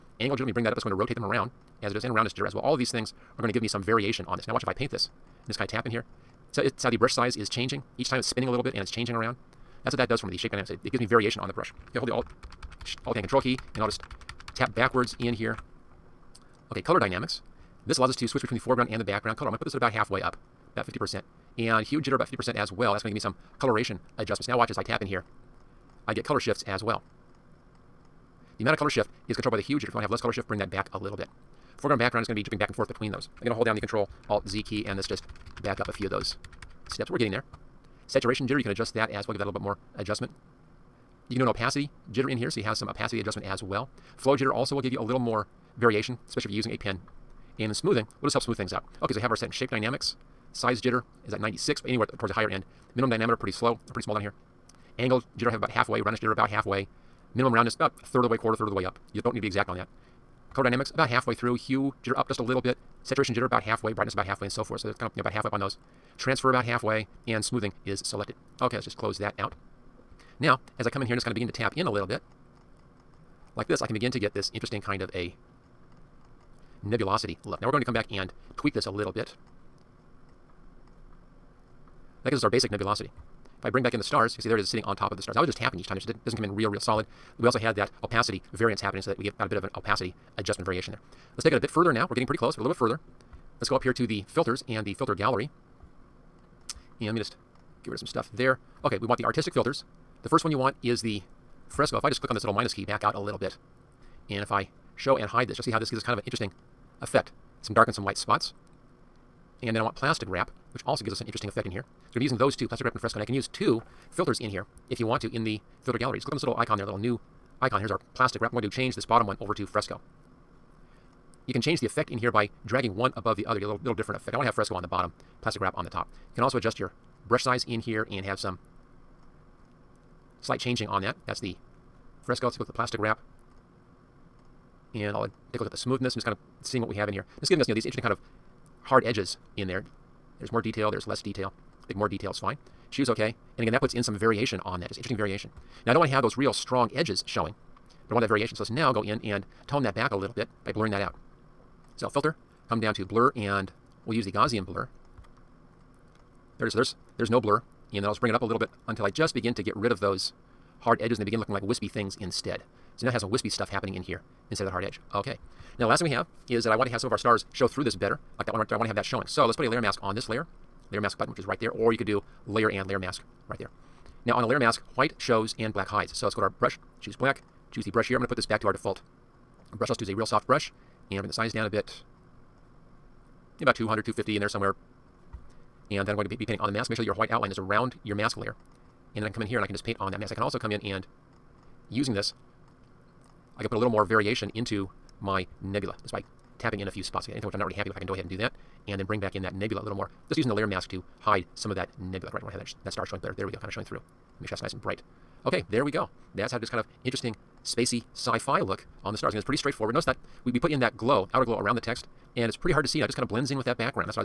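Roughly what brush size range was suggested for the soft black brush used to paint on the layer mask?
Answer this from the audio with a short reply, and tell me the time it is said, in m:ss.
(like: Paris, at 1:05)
200 to 250, at 3:03.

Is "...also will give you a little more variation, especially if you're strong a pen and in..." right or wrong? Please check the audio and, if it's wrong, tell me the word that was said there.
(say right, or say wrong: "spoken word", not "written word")
wrong: "using", not "strong".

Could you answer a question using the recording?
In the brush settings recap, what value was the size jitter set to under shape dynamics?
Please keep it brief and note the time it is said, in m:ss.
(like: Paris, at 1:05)
96, at 0:51.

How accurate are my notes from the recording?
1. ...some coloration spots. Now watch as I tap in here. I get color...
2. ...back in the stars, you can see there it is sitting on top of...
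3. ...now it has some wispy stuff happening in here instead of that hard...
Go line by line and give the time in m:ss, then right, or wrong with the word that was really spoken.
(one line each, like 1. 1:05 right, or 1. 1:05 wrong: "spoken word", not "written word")
1. 0:23 wrong: "adjustments", not "spots"
2. 1:23 right
3. 2:43 right.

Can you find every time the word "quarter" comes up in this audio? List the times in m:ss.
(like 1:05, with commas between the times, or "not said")
0:58.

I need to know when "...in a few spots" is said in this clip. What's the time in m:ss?
3:16.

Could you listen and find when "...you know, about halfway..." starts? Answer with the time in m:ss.
1:05.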